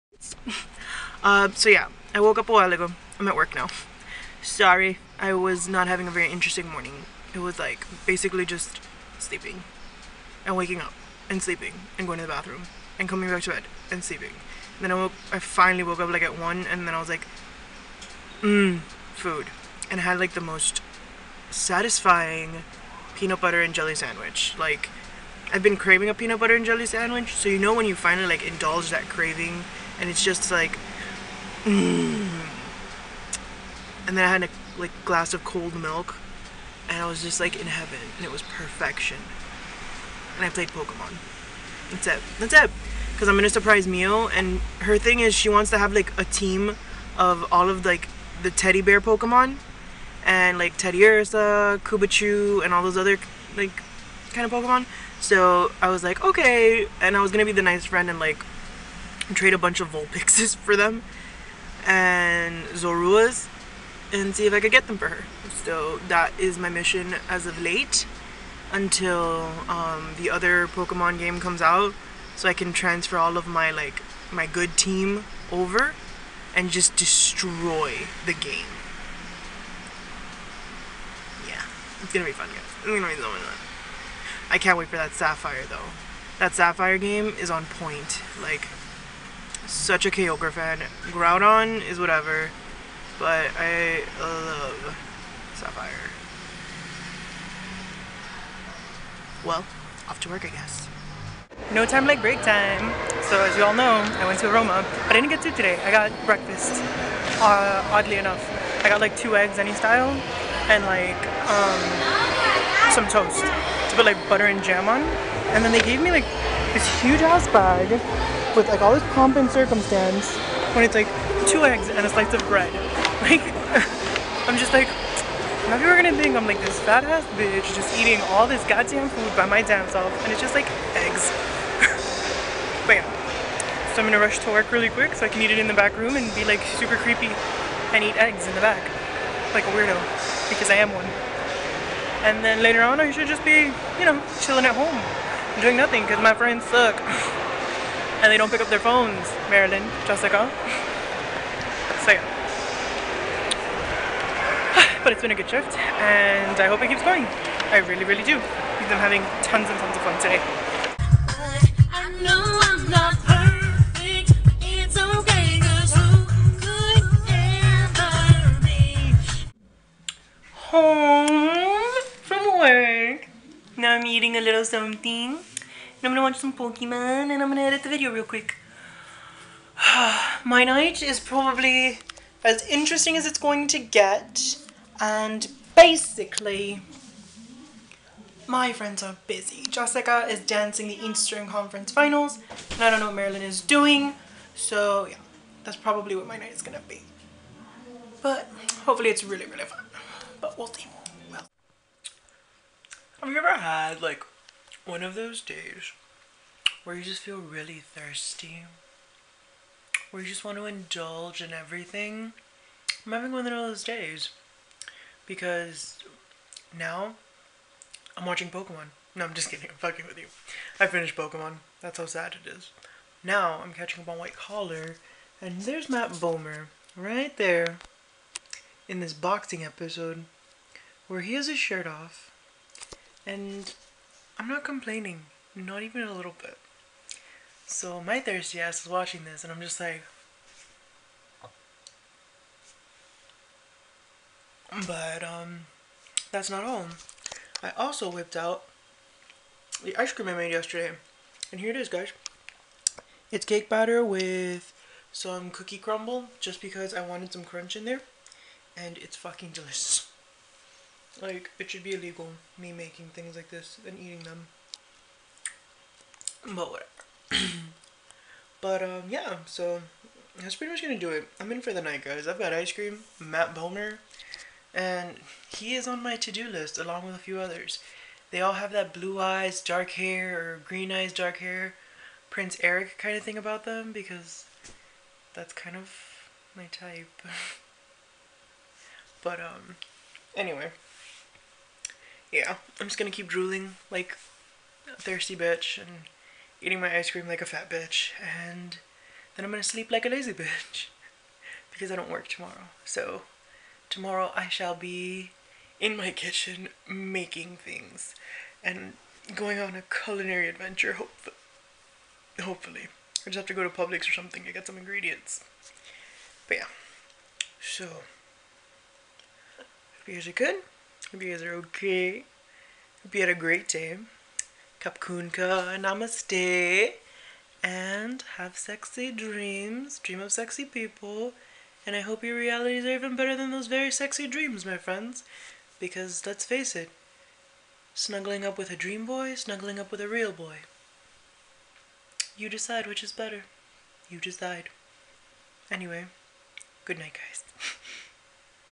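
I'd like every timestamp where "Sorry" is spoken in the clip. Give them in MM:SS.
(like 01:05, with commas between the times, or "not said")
00:04.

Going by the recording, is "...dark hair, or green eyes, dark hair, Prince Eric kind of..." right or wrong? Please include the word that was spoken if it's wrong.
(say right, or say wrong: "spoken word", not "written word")
right.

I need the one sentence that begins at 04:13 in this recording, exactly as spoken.
It's cake batter with some cookie crumble just because I wanted some crunch in there.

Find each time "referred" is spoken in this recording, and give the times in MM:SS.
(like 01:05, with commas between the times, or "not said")
not said.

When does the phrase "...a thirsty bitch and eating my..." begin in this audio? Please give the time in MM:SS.
04:54.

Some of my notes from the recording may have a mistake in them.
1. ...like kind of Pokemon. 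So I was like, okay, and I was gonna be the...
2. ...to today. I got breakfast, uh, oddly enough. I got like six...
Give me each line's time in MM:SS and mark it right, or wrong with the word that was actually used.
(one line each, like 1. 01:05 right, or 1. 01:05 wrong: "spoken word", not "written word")
1. 00:53 right
2. 01:45 wrong: "two", not "six".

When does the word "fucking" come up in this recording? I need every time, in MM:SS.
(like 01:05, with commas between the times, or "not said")
03:39, 04:19.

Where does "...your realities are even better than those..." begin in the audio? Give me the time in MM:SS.
05:32.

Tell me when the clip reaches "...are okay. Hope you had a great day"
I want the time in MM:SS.
05:21.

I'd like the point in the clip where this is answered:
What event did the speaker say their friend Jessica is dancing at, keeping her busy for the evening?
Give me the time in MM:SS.
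03:11.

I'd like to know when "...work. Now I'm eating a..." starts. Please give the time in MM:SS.
02:52.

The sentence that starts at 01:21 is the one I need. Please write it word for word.
Yeah, it's gonna be fun guys.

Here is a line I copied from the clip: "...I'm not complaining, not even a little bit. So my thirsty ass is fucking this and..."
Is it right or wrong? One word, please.
wrong.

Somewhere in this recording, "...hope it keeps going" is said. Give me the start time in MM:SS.
02:36.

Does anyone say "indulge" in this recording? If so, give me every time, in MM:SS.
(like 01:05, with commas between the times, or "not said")
00:28, 03:30.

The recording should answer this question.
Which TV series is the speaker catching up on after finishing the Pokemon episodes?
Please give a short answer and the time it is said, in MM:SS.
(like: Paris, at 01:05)
White Collar, at 03:44.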